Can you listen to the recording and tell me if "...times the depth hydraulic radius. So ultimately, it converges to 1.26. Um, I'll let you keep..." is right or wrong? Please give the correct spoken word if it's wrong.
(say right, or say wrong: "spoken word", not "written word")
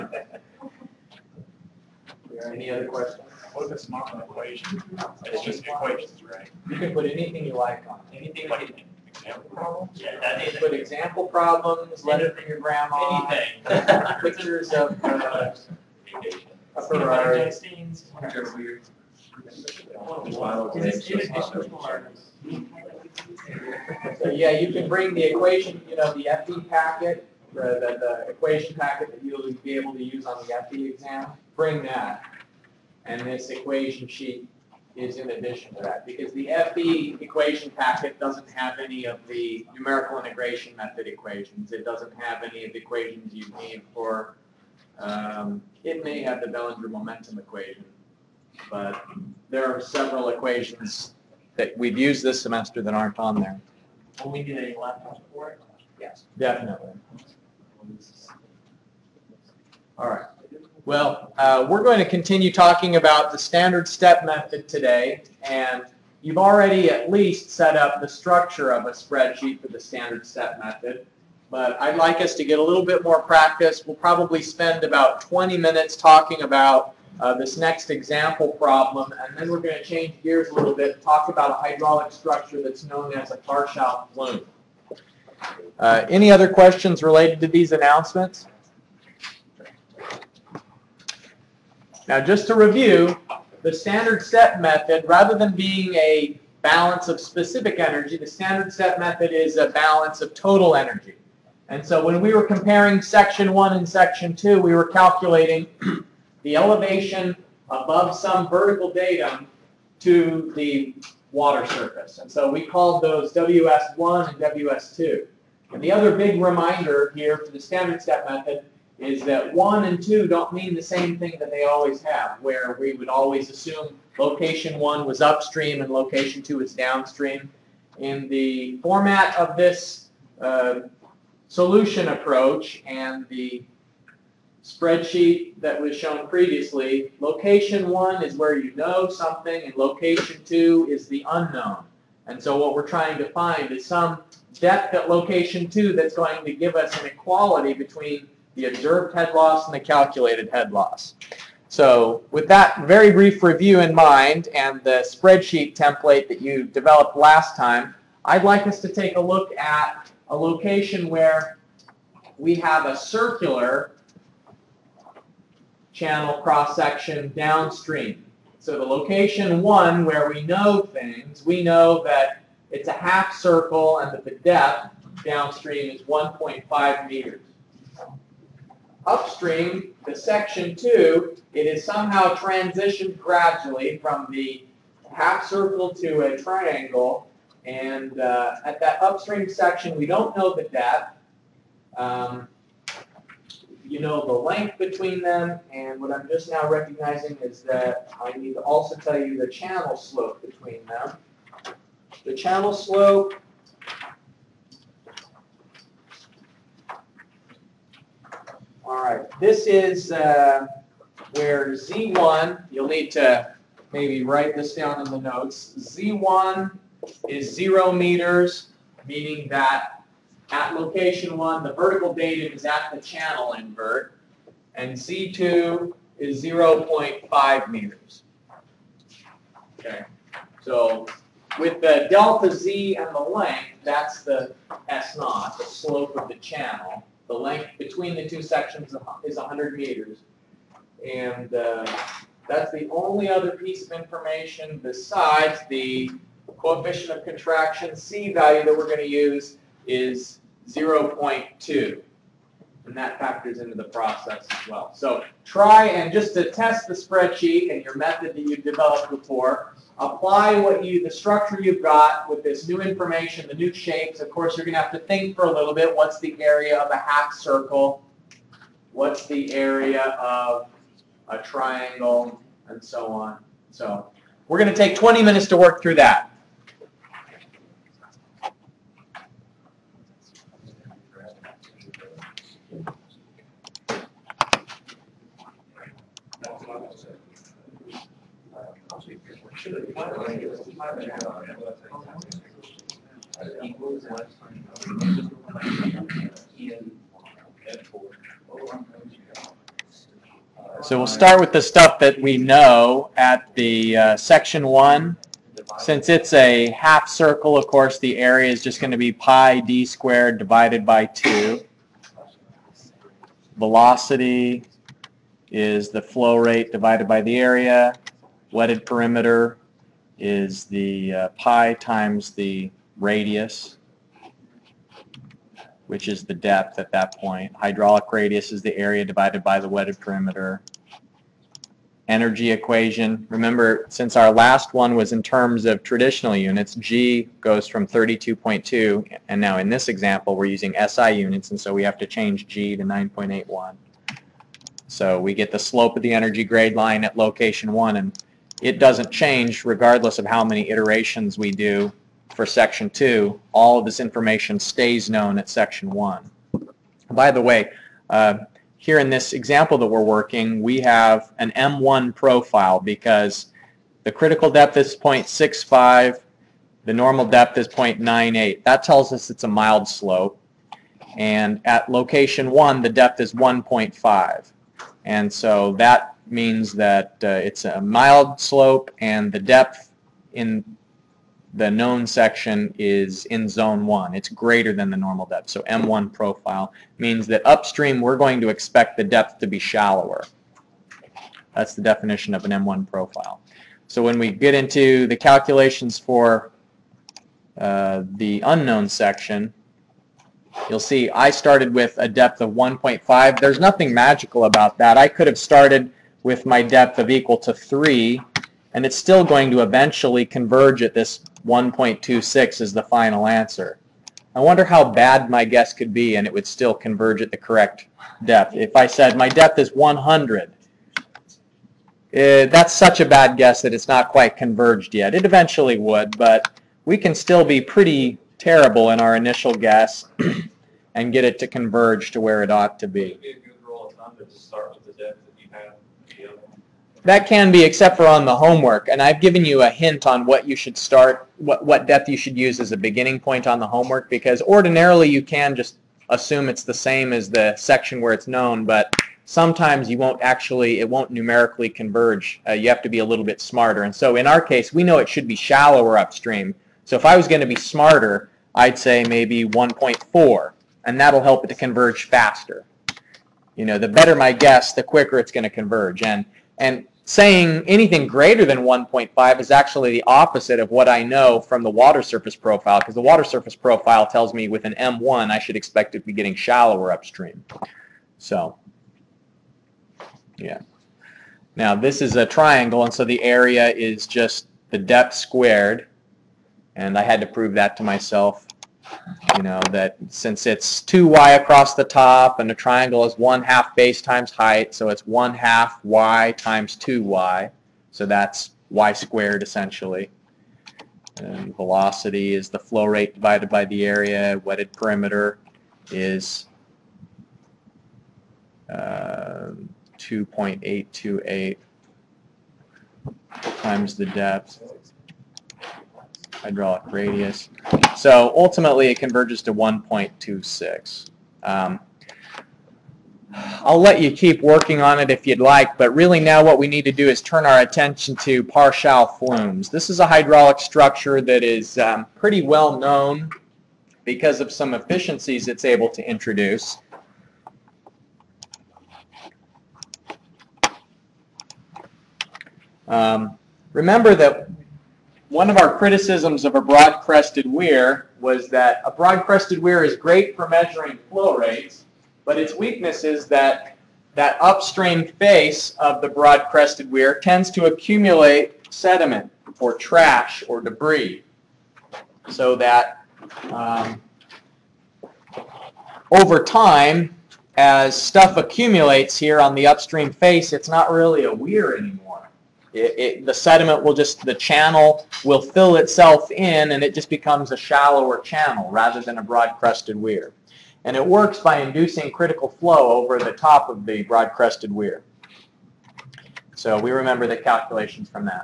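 right.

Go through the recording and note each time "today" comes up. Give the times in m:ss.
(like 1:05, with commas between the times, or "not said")
1:04.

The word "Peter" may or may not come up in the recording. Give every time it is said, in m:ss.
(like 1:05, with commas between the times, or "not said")
not said.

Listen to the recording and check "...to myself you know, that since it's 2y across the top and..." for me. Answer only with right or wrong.
right.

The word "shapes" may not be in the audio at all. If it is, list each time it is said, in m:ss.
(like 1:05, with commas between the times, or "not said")
4:23.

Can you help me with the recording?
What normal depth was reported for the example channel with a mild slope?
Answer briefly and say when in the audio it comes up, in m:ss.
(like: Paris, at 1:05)
0.98, at 6:07.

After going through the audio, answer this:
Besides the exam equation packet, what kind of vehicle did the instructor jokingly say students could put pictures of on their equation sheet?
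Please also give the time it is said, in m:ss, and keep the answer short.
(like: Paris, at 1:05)
Ferrari, at 0:16.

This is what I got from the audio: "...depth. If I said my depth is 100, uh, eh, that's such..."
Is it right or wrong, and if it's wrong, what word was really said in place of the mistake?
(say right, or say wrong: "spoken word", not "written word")
right.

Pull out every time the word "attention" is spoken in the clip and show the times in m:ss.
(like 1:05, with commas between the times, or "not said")
8:47.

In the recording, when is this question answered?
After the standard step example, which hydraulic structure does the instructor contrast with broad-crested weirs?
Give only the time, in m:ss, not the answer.
1:23.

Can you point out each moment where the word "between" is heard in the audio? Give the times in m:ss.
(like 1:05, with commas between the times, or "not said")
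2:27, 3:14, 3:20, 3:57.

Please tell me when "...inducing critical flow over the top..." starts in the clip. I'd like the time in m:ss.
9:41.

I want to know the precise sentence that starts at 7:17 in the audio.
That can be, except for on the homework.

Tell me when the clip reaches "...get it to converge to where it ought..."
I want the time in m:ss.
7:11.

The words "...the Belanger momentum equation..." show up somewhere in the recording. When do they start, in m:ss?
0:46.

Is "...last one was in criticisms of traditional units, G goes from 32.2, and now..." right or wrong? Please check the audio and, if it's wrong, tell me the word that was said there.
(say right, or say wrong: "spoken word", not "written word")
wrong: "terms", not "criticisms".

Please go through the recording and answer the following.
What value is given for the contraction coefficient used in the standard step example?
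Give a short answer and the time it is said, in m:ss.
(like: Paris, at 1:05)
0.2, at 4:10.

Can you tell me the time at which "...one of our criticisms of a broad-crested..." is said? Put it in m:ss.
9:05.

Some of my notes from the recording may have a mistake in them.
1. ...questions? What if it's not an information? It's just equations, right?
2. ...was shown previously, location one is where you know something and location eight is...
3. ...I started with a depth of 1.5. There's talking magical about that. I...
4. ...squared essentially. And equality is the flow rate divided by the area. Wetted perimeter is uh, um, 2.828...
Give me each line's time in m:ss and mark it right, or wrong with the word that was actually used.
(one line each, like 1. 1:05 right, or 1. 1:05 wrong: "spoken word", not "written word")
1. 0:02 wrong: "equation", not "information"
2. 2:15 wrong: "two", not "eight"
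3. 6:41 wrong: "nothing", not "talking"
4. 8:18 wrong: "velocity", not "equality".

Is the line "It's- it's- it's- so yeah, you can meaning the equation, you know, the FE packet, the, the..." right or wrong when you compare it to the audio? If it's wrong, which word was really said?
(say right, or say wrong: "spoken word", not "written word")
wrong: "bring", not "meaning".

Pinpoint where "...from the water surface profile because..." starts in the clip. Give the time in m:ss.
7:51.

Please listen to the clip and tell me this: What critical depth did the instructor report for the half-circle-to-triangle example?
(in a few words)
0.65.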